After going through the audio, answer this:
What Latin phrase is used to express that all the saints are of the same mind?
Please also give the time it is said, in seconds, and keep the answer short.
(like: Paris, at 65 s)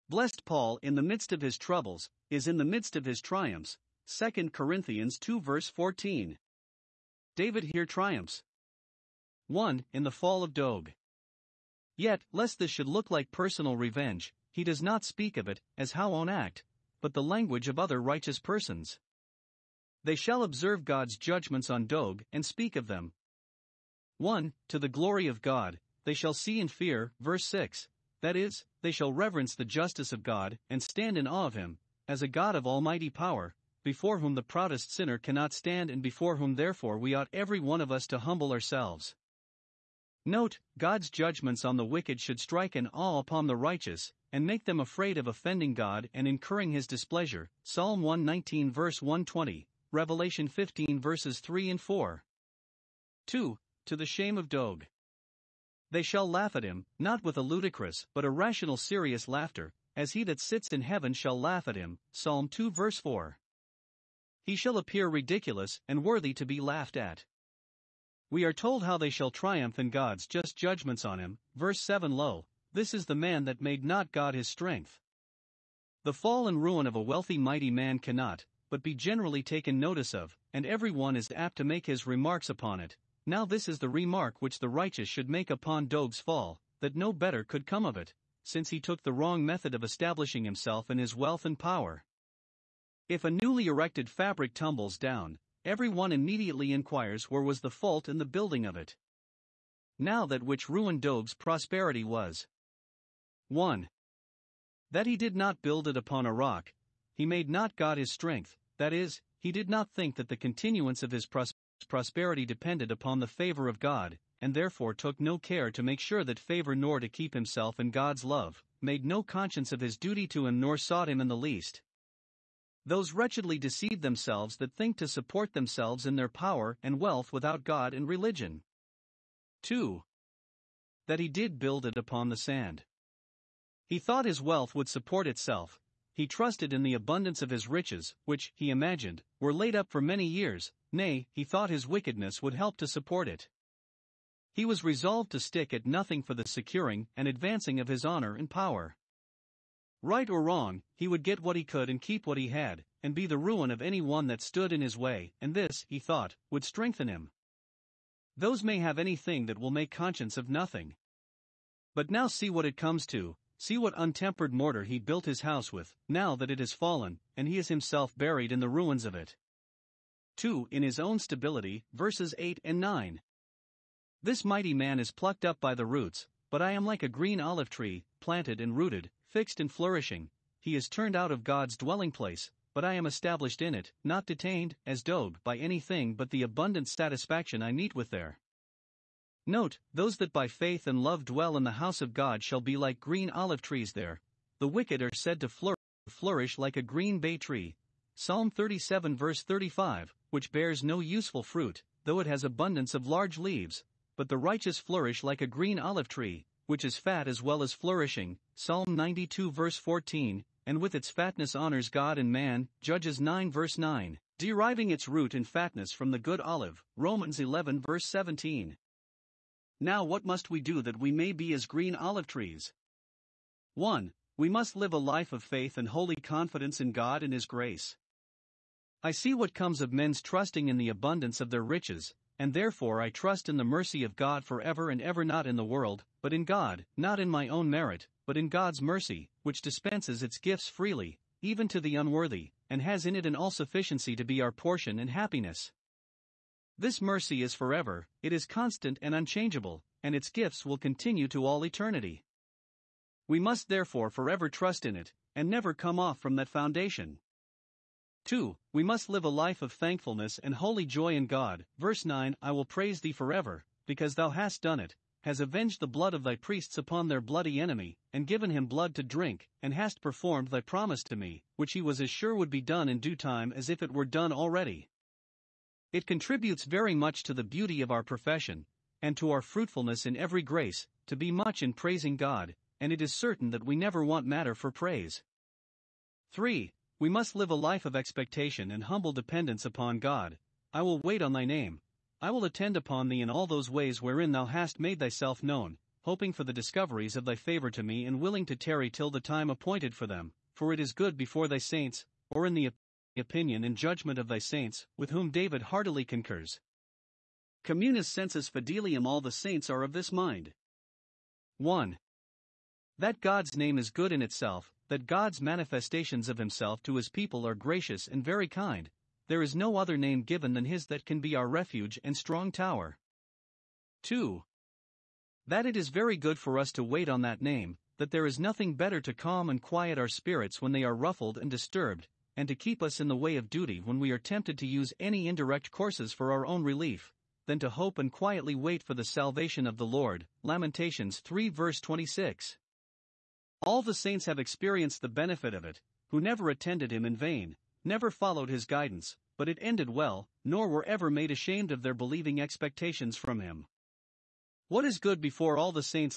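Communis sensus fidelium, at 307 s.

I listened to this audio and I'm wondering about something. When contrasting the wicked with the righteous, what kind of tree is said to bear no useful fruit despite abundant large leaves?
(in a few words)
green bay tree.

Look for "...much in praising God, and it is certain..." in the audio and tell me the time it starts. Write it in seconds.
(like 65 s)
281 s.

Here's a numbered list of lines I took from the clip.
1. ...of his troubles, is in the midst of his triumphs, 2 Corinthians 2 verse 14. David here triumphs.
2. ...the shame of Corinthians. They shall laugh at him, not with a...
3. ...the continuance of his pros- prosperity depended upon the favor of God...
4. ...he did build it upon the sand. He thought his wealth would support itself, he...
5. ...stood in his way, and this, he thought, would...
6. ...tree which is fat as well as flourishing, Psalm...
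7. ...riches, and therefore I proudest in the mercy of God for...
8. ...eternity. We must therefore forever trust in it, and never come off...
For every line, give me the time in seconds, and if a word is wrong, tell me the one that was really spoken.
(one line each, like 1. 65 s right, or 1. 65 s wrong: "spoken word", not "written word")
1. 1 s right
2. 53 s wrong: "Doeg", not "Corinthians"
3. 110 s right
4. 131 s right
5. 154 s right
6. 206 s right
7. 231 s wrong: "trust", not "proudest"
8. 251 s right.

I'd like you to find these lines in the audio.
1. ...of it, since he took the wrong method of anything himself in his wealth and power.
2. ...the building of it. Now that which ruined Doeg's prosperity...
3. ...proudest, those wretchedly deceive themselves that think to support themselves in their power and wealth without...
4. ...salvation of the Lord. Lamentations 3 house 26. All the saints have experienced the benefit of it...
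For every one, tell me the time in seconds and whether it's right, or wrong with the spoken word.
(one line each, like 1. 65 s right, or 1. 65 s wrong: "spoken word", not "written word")
1. 87 s wrong: "establishing", not "anything"
2. 98 s right
3. 121 s wrong: "least", not "proudest"
4. 339 s wrong: "verse", not "house".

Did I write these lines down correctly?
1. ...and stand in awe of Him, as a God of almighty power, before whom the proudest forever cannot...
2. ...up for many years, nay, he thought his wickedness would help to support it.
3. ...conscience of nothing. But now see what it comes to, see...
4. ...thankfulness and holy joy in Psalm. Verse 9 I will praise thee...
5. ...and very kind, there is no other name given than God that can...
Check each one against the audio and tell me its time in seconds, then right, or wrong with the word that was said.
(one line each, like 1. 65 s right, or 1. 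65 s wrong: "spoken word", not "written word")
1. 30 s wrong: "sinner", not "forever"
2. 139 s right
3. 159 s right
4. 259 s wrong: "God", not "Psalm"
5. 318 s wrong: "His", not "God".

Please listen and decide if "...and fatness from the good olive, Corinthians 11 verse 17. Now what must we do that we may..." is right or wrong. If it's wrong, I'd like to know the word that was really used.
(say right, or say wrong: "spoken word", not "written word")
wrong: "Romans", not "Corinthians".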